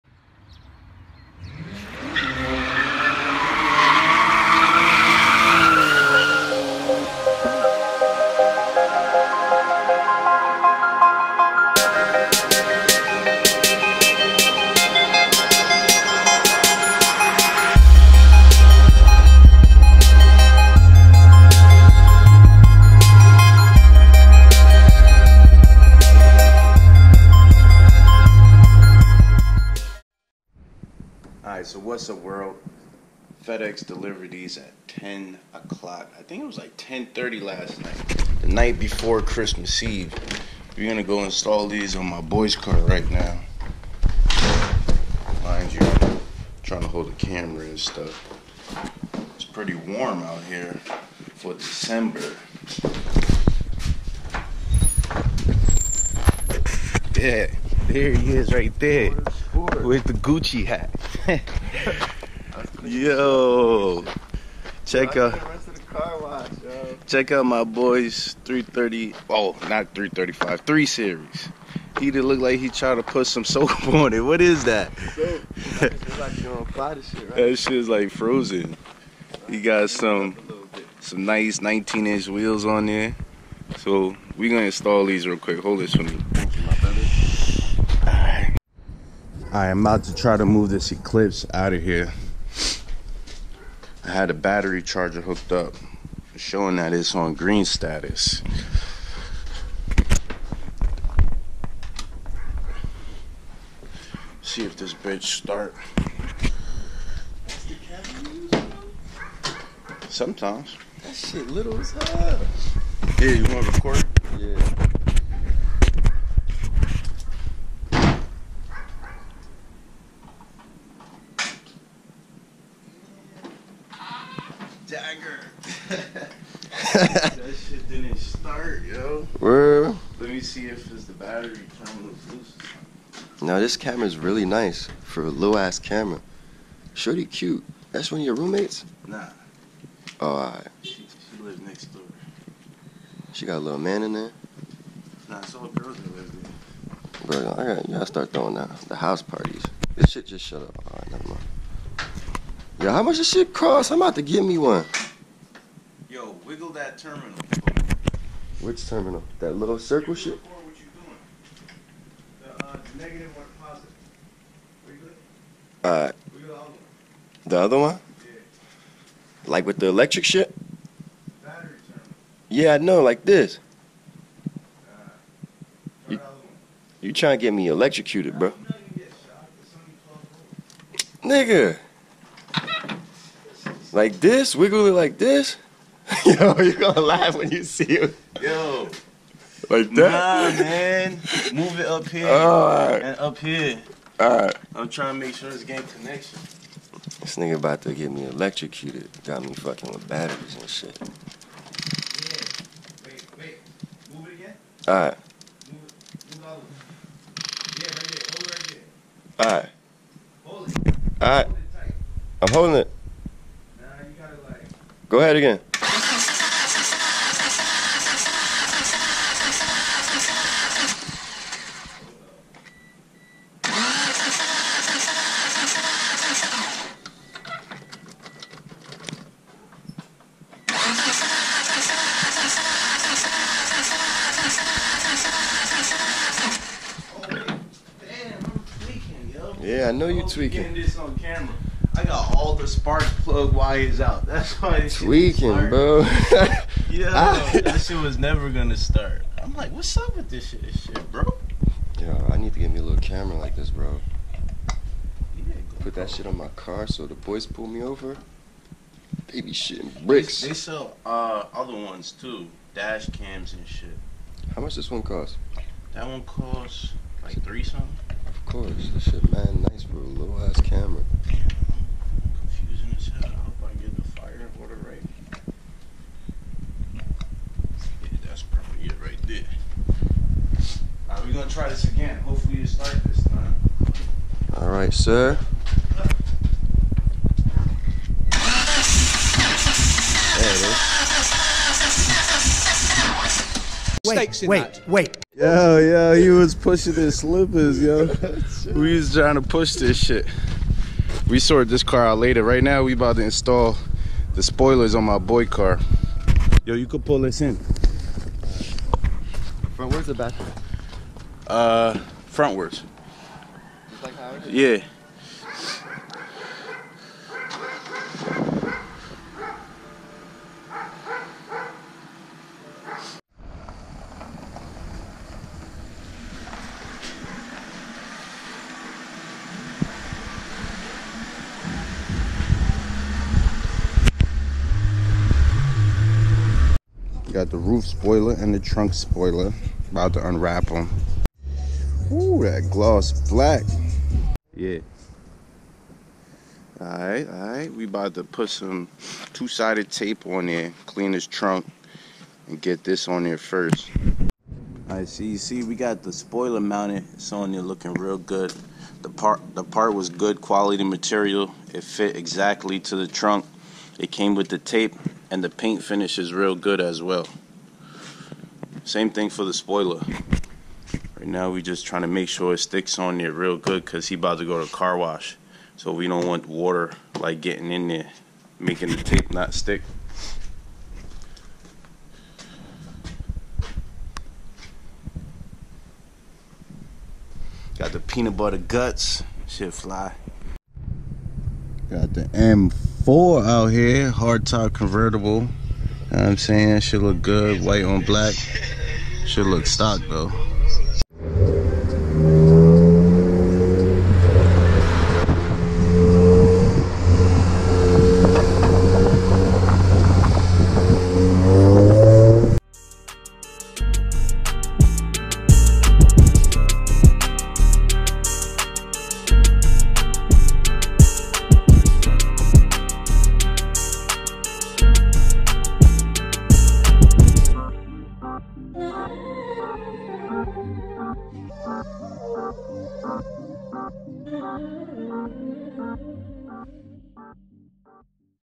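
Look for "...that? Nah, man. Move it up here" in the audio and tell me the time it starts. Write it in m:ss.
3:09.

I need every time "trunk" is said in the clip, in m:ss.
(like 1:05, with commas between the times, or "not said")
5:38, 5:51, 6:03.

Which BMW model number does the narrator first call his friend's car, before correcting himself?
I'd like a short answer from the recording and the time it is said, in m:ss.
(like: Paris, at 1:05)
330, at 1:08.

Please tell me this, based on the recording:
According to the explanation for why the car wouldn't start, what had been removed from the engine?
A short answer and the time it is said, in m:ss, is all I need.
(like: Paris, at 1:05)
spark plug wires, at 4:02.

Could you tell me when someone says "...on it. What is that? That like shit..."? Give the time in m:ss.
1:13.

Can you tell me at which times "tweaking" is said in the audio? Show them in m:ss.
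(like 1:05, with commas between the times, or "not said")
4:00, 4:04.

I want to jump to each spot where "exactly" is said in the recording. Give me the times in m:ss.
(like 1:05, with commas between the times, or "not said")
6:02.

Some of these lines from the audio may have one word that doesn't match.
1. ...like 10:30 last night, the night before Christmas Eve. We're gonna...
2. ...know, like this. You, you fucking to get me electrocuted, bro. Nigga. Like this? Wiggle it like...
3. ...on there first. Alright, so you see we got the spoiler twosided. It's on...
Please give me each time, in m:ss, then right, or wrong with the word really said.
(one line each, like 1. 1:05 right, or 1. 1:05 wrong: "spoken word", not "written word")
1. 0:36 right
2. 2:52 wrong: "trying", not "fucking"
3. 5:53 wrong: "mounted", not "twosided".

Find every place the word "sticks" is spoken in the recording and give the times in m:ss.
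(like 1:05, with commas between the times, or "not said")
6:12, 6:19.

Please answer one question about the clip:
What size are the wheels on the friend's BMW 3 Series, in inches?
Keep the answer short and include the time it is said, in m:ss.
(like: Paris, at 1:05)
19, at 1:21.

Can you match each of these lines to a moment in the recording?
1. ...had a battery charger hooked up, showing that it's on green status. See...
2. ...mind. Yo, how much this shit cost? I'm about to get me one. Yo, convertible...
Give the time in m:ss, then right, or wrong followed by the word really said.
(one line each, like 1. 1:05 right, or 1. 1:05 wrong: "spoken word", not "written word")
1. 1:34 right
2. 2:31 wrong: "wiggle", not "convertible".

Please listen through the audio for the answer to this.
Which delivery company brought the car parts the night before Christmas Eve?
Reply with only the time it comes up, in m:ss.
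0:33.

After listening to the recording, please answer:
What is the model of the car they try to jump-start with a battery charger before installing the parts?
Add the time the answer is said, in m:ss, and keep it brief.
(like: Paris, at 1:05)
Eclipse, at 1:30.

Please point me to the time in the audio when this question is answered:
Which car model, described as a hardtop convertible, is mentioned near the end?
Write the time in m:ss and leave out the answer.
6:32.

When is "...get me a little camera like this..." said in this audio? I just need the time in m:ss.
4:12.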